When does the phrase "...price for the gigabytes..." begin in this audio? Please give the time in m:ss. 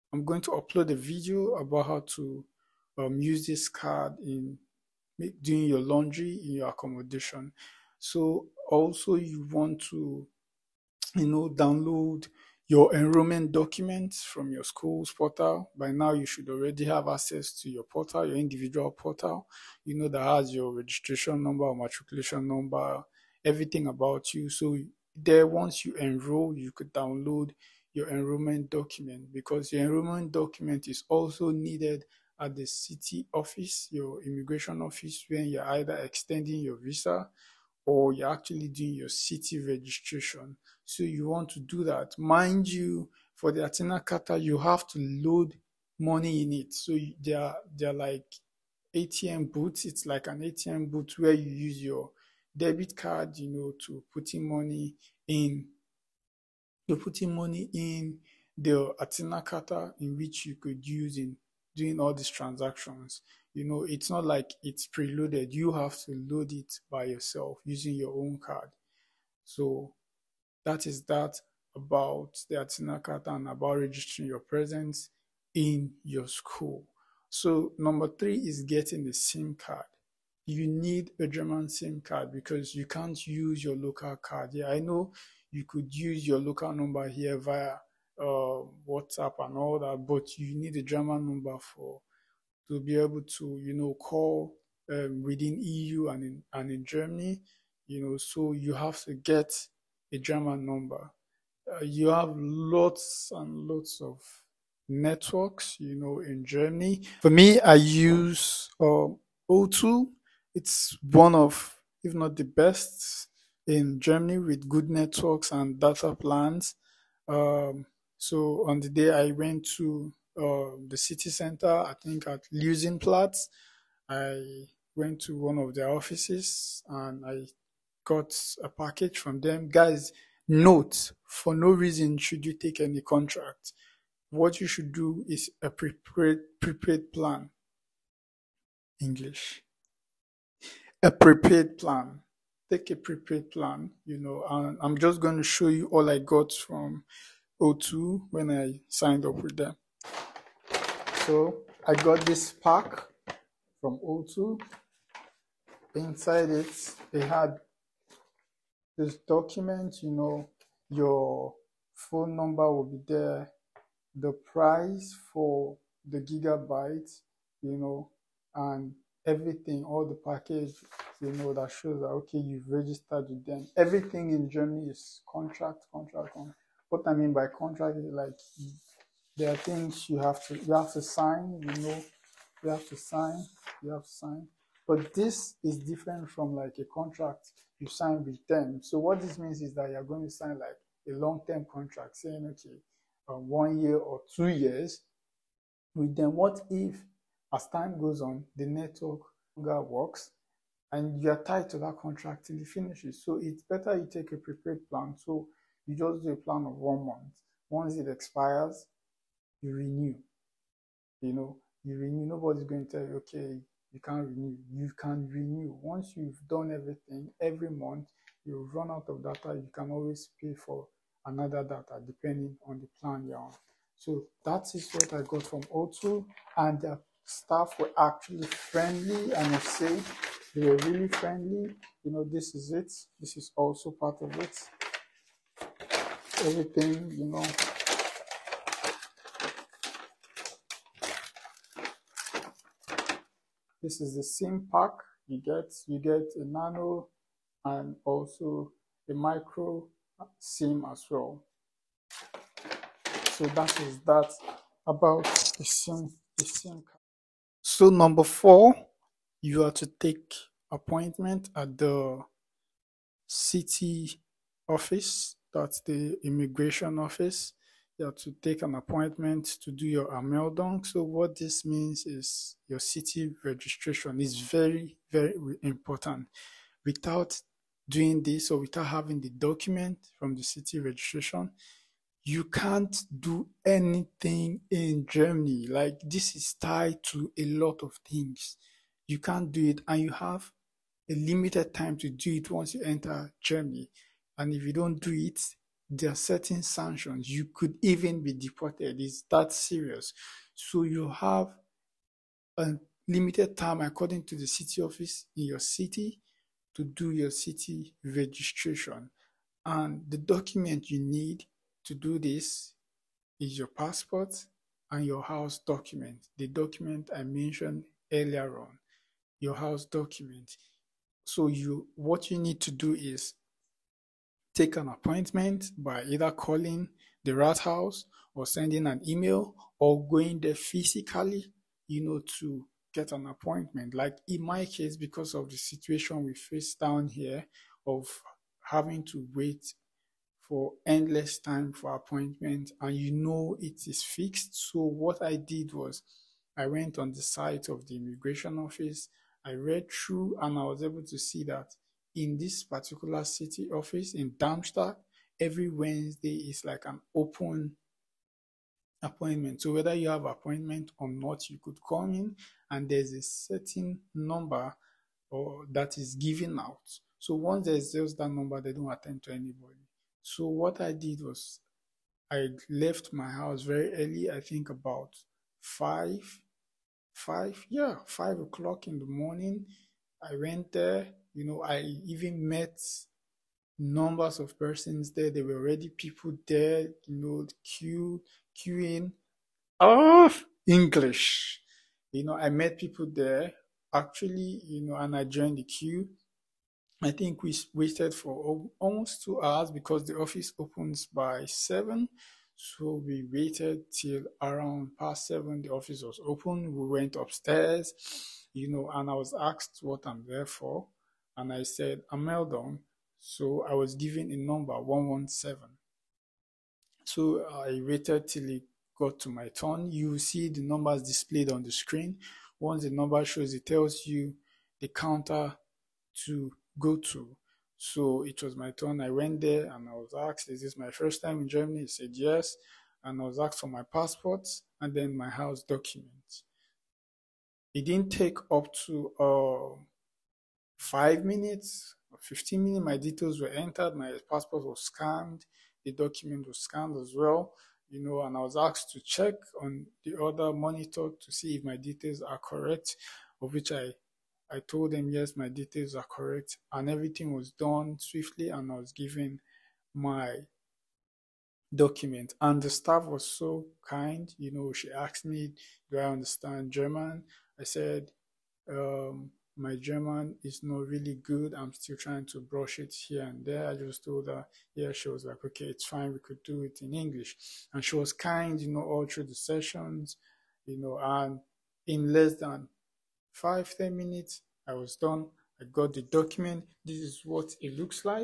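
2:44.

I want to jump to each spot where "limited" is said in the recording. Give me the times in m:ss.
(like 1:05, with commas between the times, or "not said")
4:51, 5:03.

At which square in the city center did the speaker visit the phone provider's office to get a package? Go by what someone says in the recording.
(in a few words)
Luisenplatz.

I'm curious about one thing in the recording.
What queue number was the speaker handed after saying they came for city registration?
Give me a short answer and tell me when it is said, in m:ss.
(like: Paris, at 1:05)
117, at 6:54.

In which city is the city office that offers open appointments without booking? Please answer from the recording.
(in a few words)
Darmstadt.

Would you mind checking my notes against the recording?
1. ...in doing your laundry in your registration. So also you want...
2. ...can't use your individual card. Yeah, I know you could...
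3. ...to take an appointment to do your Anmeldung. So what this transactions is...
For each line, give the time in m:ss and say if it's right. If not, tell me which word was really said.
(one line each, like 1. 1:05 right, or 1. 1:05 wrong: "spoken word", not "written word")
1. 0:04 wrong: "accommodation", not "registration"
2. 1:22 wrong: "local", not "individual"
3. 4:28 wrong: "means", not "transactions".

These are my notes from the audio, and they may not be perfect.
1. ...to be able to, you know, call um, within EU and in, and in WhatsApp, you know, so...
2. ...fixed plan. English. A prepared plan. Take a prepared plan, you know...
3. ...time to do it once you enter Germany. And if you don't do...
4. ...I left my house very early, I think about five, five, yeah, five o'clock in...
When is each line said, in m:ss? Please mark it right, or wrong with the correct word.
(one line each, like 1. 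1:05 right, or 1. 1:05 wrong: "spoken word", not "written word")
1. 1:32 wrong: "Germany", not "WhatsApp"
2. 2:16 wrong: "prepared", not "fixed"
3. 4:51 right
4. 6:12 right.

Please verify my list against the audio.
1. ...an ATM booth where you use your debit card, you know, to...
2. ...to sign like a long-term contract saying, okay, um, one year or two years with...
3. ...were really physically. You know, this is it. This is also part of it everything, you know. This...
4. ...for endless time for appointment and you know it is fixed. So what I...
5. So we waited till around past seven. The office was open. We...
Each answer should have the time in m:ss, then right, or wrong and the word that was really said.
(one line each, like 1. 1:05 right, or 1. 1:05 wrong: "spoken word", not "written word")
1. 0:50 right
2. 3:10 right
3. 3:50 wrong: "friendly", not "physically"
4. 5:40 right
5. 6:42 right.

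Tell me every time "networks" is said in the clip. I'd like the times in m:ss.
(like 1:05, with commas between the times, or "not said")
1:44, 1:54, 3:18.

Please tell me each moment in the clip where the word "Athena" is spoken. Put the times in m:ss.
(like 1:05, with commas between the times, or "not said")
0:43, 0:58.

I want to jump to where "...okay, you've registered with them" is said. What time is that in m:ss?
2:52.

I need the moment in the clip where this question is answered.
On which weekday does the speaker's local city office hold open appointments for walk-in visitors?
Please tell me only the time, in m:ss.
5:55.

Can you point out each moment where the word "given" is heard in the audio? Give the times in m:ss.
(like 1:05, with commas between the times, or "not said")
6:06, 6:53, 7:38.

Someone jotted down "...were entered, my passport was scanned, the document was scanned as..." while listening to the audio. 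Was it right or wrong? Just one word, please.
right.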